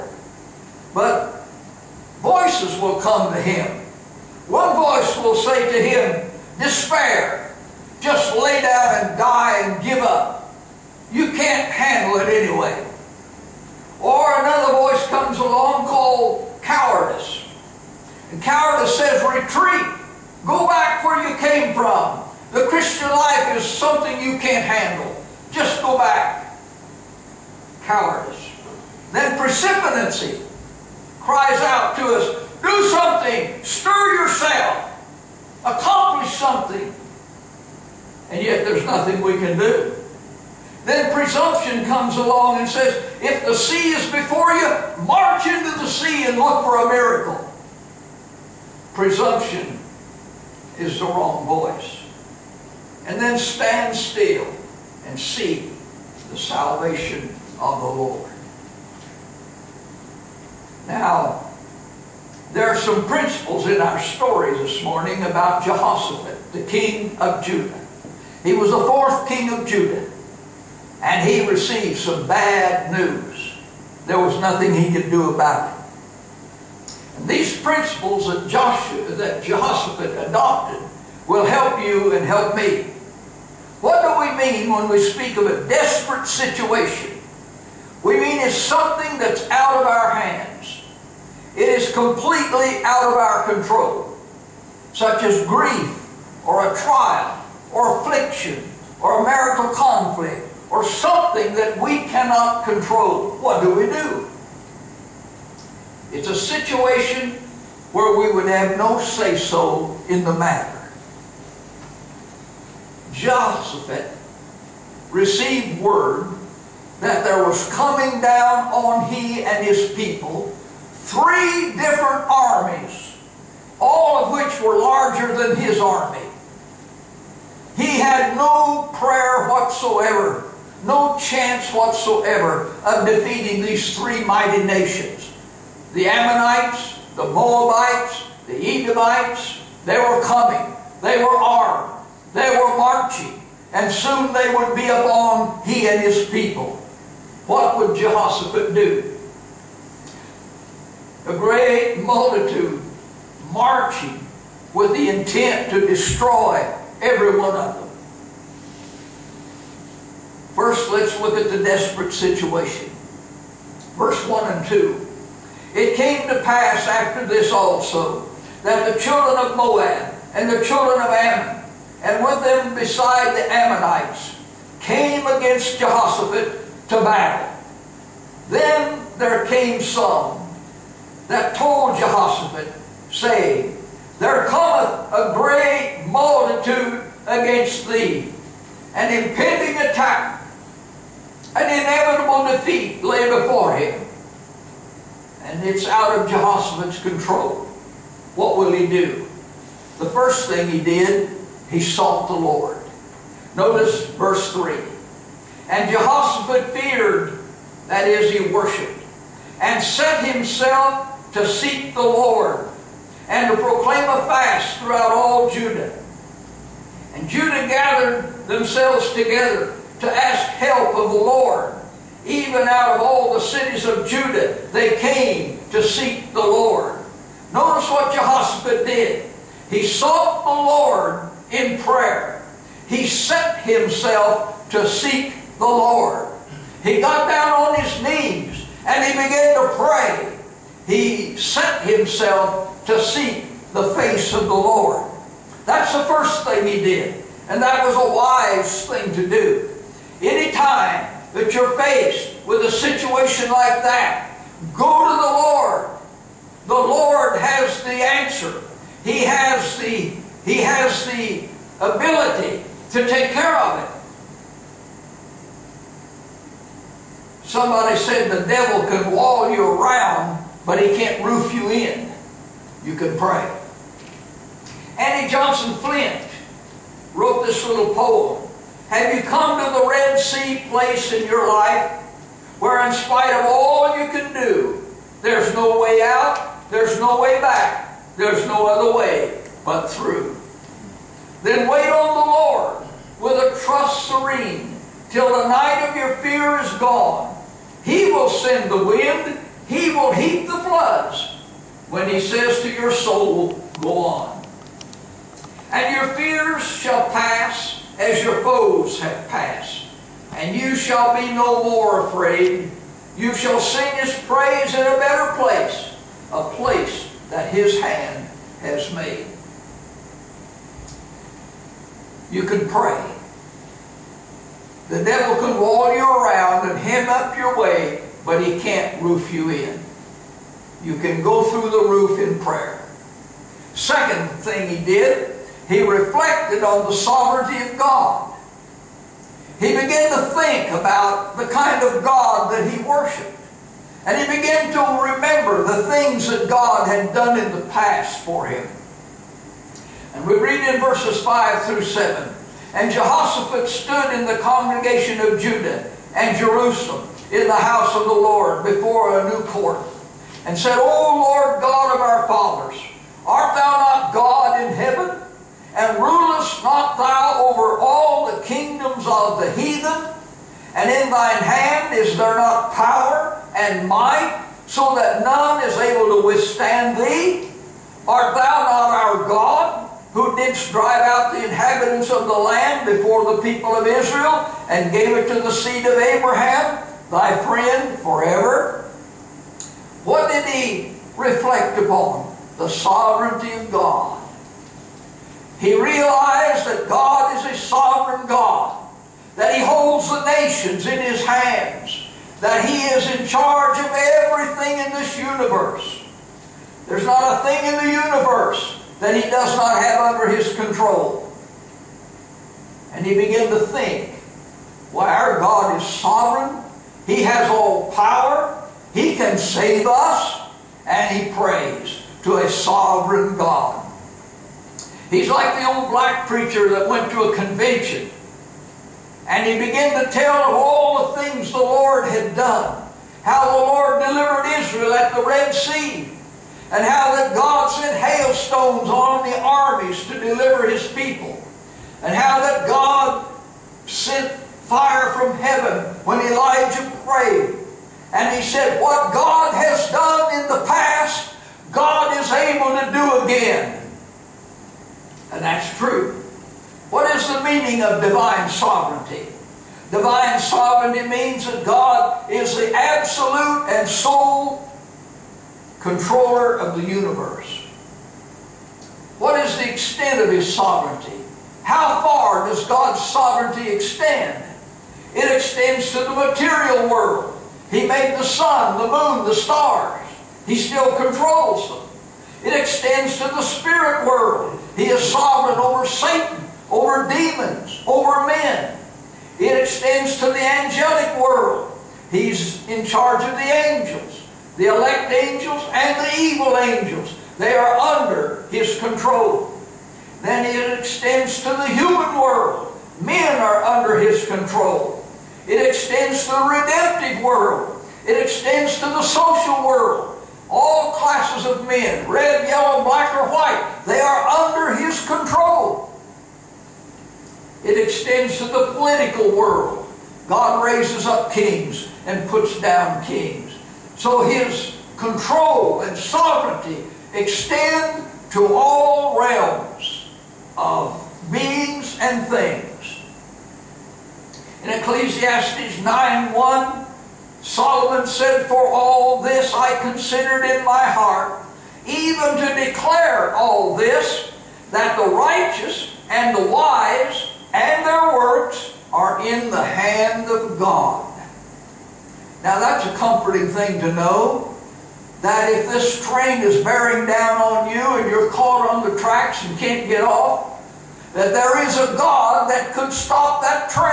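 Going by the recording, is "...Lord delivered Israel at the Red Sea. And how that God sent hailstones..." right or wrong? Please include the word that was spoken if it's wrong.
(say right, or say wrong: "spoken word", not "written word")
right.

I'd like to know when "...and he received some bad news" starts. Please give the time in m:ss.
1:11.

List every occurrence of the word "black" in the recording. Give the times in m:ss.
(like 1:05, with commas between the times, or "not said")
7:05, 8:32.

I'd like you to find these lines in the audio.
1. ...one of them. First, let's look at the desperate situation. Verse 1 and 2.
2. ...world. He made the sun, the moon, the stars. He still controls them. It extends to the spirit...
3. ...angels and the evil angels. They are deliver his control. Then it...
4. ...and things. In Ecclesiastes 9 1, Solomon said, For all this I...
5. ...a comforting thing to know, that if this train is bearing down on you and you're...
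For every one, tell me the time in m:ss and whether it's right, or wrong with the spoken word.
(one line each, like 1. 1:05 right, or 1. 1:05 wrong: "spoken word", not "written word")
1. 2:37 right
2. 7:56 right
3. 8:15 wrong: "under", not "deliver"
4. 8:51 right
5. 9:12 right.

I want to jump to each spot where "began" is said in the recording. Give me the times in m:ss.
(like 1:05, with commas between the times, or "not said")
3:59, 5:39, 5:44, 6:53, 7:09.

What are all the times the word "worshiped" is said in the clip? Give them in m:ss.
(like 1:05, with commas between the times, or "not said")
3:28, 5:42.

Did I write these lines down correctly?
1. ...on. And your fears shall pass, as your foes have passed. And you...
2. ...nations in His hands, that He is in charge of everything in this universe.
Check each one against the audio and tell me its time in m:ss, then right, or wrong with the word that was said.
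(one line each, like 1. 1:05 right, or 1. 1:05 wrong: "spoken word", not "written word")
1. 5:04 right
2. 6:40 right.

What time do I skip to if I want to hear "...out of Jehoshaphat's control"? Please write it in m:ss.
3:15.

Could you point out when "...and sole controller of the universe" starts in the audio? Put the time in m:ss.
7:43.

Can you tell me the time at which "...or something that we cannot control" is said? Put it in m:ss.
1:40.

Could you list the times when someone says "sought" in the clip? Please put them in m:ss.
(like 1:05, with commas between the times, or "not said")
3:21, 3:49.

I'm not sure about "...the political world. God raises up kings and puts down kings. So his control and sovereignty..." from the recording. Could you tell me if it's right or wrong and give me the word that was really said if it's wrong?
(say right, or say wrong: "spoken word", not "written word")
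right.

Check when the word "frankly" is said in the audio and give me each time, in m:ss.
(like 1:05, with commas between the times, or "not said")
not said.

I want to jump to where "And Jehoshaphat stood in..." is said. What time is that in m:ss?
5:52.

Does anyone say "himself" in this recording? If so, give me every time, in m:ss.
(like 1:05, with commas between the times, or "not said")
3:30, 3:53, 4:01.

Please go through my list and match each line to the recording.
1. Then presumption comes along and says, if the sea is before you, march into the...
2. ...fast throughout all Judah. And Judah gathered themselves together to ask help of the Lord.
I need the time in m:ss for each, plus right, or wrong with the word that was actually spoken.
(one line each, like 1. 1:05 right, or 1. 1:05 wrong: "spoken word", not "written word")
1. 0:40 right
2. 3:34 right.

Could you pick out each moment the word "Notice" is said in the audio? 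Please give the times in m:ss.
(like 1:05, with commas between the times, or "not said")
3:23, 3:47.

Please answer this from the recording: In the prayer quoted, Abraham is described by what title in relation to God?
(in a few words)
Thy friend.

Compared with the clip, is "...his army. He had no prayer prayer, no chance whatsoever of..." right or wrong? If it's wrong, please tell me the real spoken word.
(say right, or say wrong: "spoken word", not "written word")
wrong: "whatsoever", not "prayer".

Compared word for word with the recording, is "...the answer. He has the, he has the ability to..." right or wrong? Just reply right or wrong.
right.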